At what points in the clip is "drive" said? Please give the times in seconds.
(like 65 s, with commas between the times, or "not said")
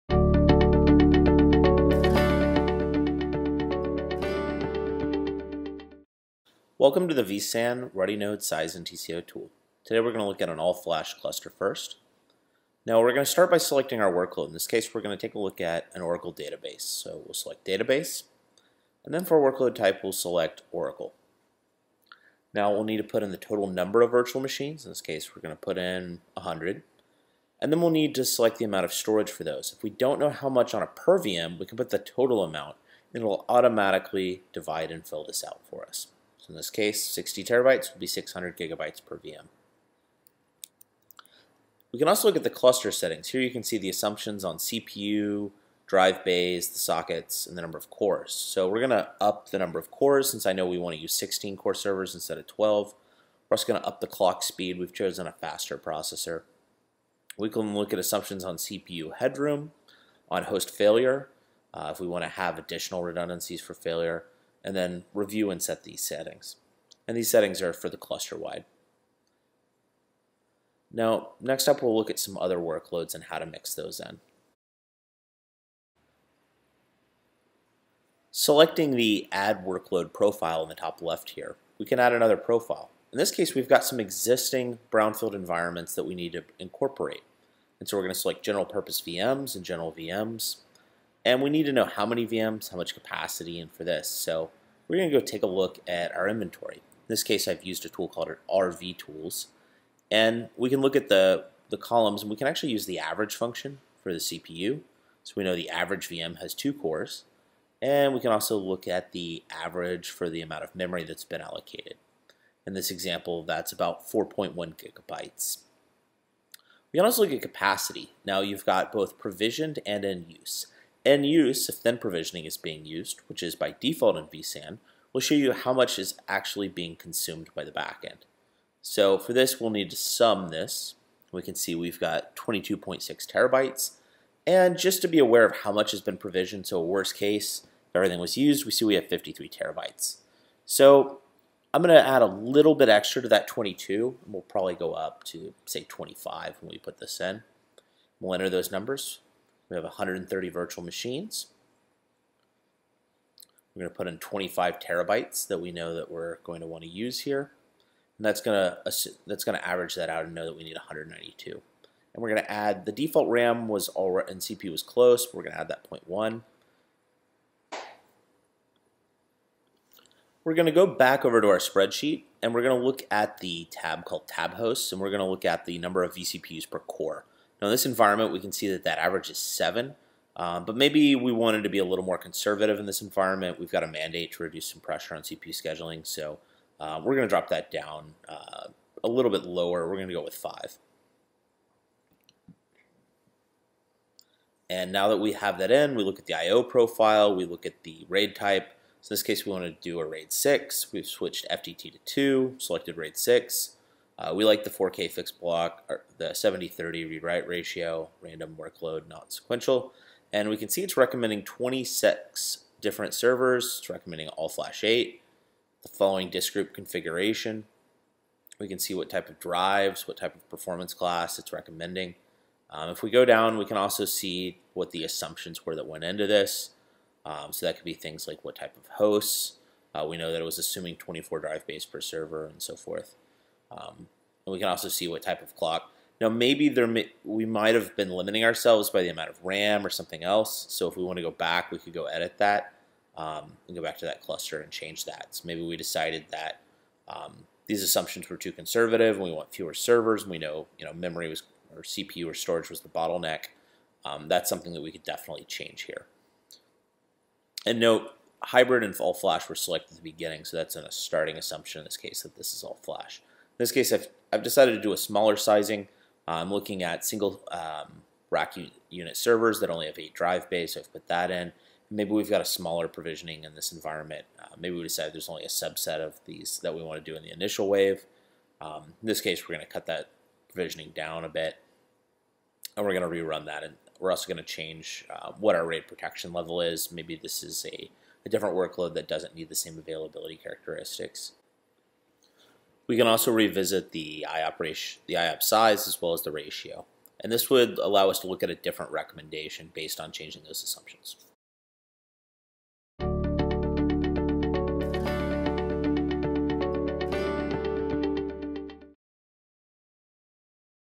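45 s, 219 s, 231 s, 270 s.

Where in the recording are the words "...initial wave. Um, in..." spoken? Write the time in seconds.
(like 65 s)
277 s.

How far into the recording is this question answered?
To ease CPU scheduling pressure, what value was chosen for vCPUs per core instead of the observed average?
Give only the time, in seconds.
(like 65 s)
190 s.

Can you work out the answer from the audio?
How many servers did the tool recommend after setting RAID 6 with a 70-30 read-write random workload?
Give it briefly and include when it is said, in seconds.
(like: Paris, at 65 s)
26, at 211 s.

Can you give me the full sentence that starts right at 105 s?
So we know the average VM has two cores.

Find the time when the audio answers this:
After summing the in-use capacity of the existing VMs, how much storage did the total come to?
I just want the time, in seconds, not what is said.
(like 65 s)
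132 s.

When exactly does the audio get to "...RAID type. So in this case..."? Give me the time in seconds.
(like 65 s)
198 s.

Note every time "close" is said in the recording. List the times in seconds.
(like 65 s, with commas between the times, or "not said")
164 s.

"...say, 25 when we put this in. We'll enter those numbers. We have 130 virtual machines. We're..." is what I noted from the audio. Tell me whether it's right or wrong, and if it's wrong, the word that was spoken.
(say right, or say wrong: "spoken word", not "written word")
right.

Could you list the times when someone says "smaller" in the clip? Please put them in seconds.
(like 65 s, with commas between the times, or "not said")
264 s, 272 s.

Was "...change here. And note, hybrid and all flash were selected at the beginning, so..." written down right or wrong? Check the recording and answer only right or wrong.
right.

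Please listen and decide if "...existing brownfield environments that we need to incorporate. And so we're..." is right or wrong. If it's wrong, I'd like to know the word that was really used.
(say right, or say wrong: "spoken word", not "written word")
right.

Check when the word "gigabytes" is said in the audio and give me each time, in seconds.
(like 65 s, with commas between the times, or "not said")
38 s, 114 s.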